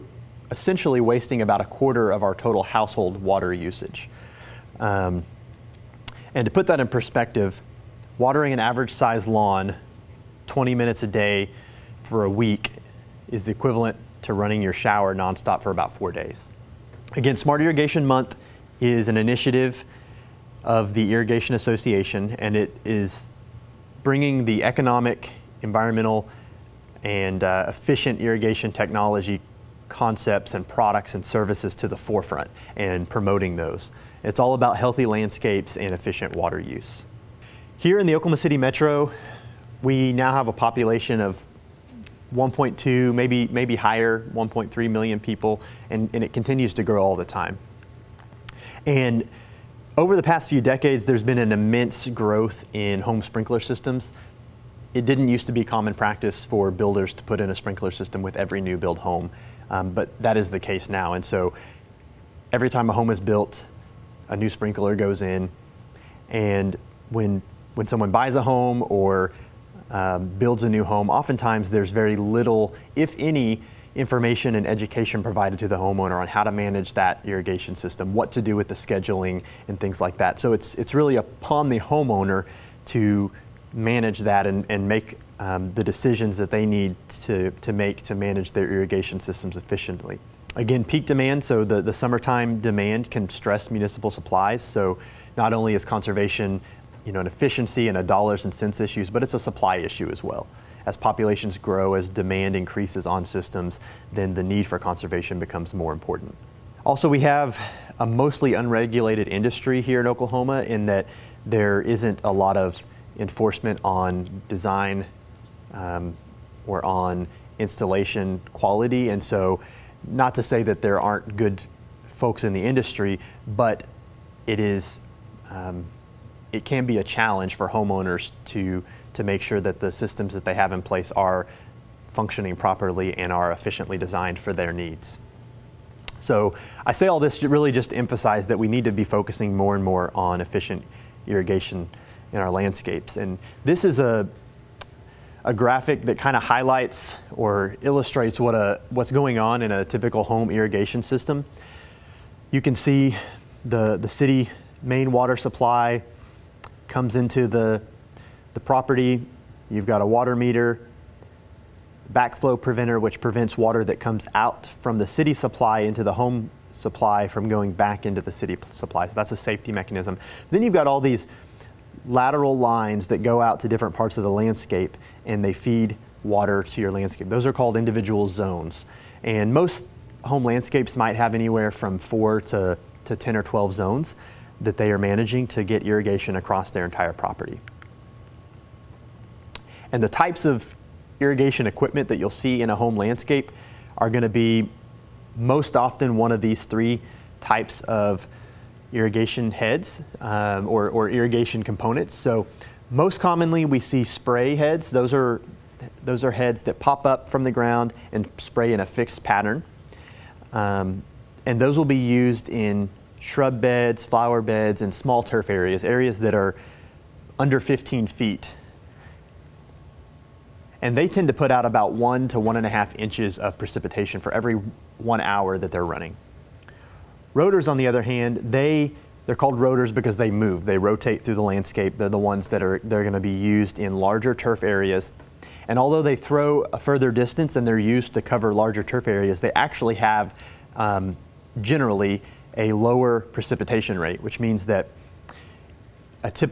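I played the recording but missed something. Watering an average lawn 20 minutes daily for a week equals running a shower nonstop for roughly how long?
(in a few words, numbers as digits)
4 days.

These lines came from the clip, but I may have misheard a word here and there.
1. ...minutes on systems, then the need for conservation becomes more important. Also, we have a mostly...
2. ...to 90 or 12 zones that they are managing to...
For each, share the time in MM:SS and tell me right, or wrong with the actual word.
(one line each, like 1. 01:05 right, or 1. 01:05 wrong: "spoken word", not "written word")
1. 01:42 wrong: "increases", not "minutes"
2. 03:03 wrong: "10", not "90".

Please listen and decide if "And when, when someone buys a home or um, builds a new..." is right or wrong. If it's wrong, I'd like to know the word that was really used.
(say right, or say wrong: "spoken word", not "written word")
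right.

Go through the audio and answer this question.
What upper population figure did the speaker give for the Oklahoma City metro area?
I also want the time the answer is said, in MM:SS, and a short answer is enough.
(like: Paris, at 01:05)
1.3 million, at 00:44.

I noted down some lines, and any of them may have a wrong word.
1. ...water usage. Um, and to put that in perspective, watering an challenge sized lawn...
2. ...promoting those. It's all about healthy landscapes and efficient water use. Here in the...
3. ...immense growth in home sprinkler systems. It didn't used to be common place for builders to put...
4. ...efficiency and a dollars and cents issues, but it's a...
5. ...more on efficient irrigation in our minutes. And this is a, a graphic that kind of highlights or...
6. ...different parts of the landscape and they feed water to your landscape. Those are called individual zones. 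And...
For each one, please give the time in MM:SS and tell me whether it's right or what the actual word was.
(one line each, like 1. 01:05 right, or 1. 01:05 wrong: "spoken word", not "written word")
1. 00:03 wrong: "average", not "challenge"
2. 00:33 right
3. 00:51 wrong: "practice", not "place"
4. 01:37 right
5. 02:19 wrong: "landscapes", not "minutes"
6. 02:53 right.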